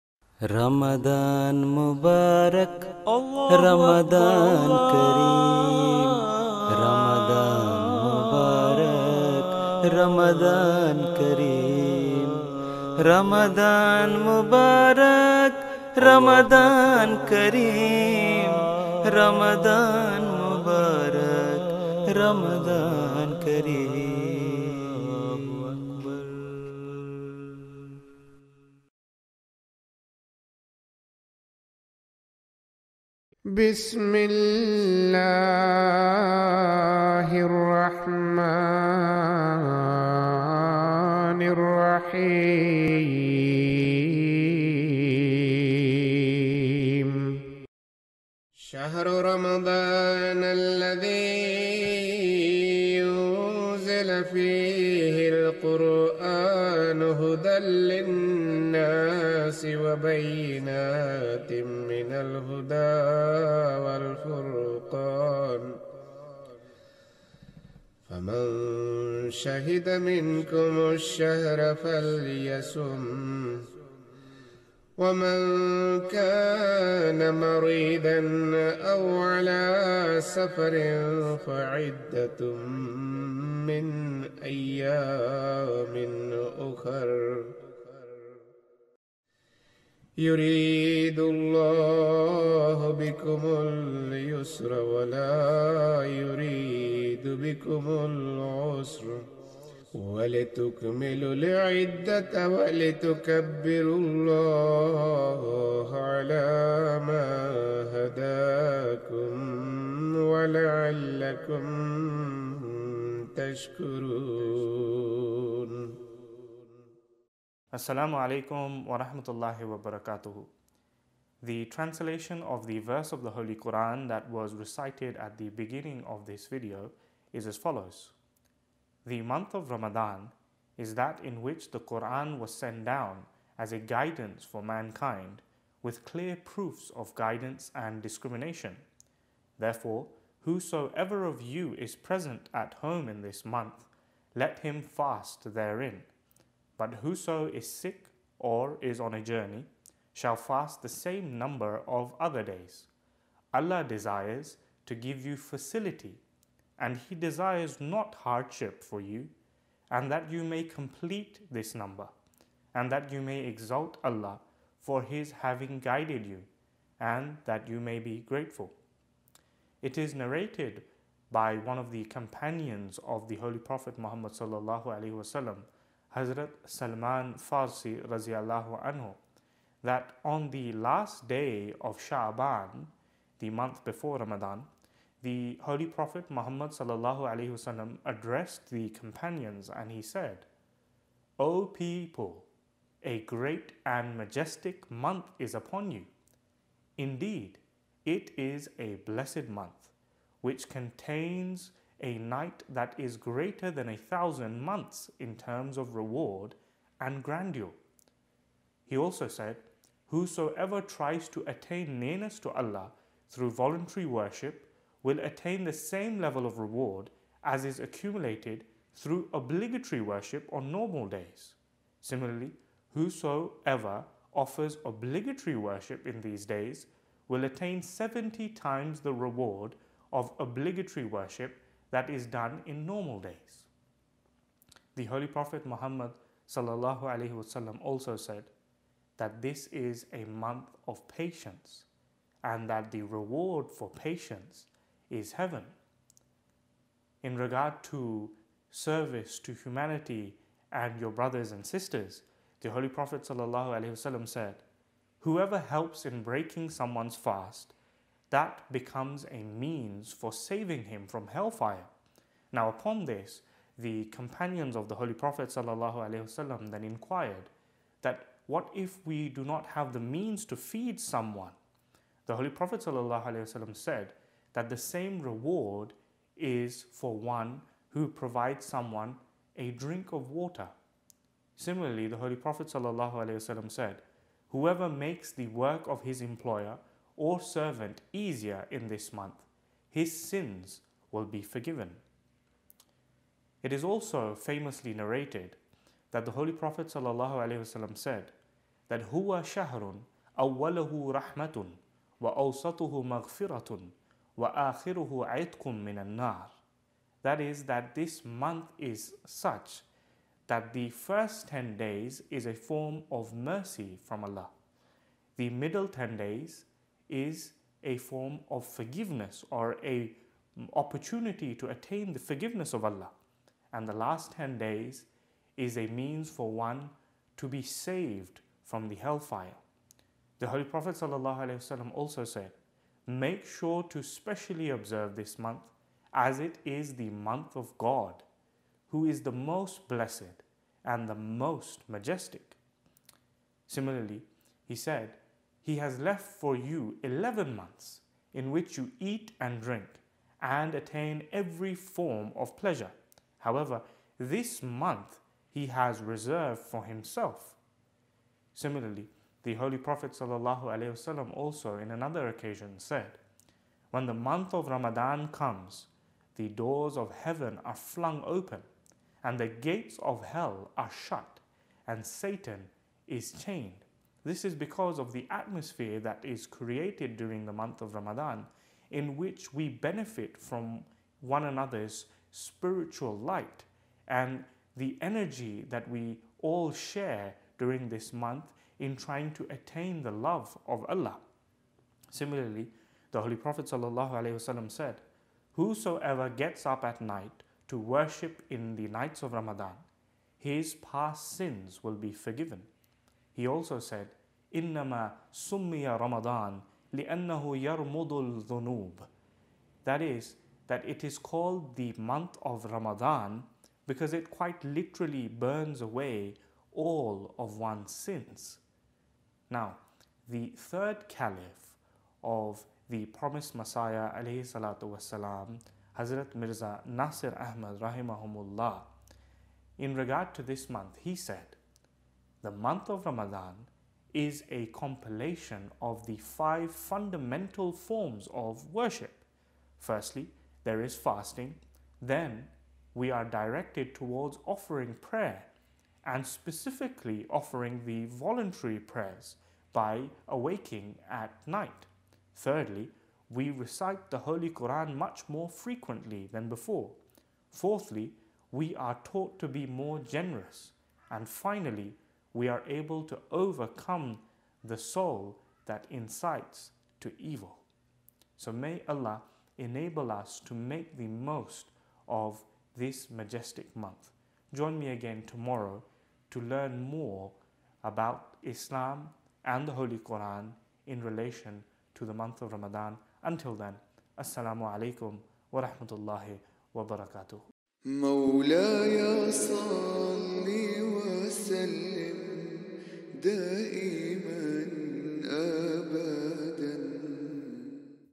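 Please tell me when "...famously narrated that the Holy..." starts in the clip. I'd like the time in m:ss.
4:54.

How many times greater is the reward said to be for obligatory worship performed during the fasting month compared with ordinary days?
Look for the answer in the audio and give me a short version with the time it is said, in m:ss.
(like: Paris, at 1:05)
70, at 3:47.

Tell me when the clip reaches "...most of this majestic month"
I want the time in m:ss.
7:51.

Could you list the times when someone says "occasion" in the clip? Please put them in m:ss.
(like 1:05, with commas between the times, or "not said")
6:02.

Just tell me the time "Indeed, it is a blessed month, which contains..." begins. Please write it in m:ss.
3:16.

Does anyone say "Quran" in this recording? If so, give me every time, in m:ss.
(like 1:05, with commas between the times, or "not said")
2:03, 2:11, 7:34, 7:59.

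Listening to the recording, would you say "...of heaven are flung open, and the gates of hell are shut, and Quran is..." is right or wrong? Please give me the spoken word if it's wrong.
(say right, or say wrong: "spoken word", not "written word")
wrong: "Satan", not "Quran".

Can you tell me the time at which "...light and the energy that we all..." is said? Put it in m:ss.
6:23.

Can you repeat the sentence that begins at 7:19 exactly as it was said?
Firstly, there is fasting, then we are directed towards offering prayer and specifically offering the voluntary prayers by awaking at night.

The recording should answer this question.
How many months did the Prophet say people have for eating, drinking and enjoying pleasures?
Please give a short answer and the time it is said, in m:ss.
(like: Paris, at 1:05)
11, at 5:47.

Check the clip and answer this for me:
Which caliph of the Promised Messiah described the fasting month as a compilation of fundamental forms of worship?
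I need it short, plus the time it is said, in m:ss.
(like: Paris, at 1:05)
Hazrat Mirza Nasir Ahmad, at 7:05.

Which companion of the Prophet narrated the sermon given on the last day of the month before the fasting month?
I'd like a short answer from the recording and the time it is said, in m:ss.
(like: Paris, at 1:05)
Hazrat Salman Farsi, at 2:56.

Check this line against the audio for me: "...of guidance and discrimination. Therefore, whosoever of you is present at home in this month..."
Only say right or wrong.
right.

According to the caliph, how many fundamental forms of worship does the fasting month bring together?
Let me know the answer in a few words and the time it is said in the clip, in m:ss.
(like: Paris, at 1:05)
5, at 7:16.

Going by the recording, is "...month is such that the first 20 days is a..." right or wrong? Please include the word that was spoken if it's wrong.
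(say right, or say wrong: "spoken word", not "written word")
wrong: "10", not "20".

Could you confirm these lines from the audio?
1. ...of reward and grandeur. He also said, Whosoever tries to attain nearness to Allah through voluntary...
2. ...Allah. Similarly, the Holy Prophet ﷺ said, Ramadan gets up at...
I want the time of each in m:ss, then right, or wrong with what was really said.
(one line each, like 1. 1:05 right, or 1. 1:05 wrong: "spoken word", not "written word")
1. 3:25 right
2. 6:30 wrong: "Whosoever", not "Ramadan".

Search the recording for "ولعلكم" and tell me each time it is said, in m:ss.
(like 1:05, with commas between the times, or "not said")
1:50.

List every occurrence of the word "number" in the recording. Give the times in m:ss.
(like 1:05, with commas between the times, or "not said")
2:31, 2:41.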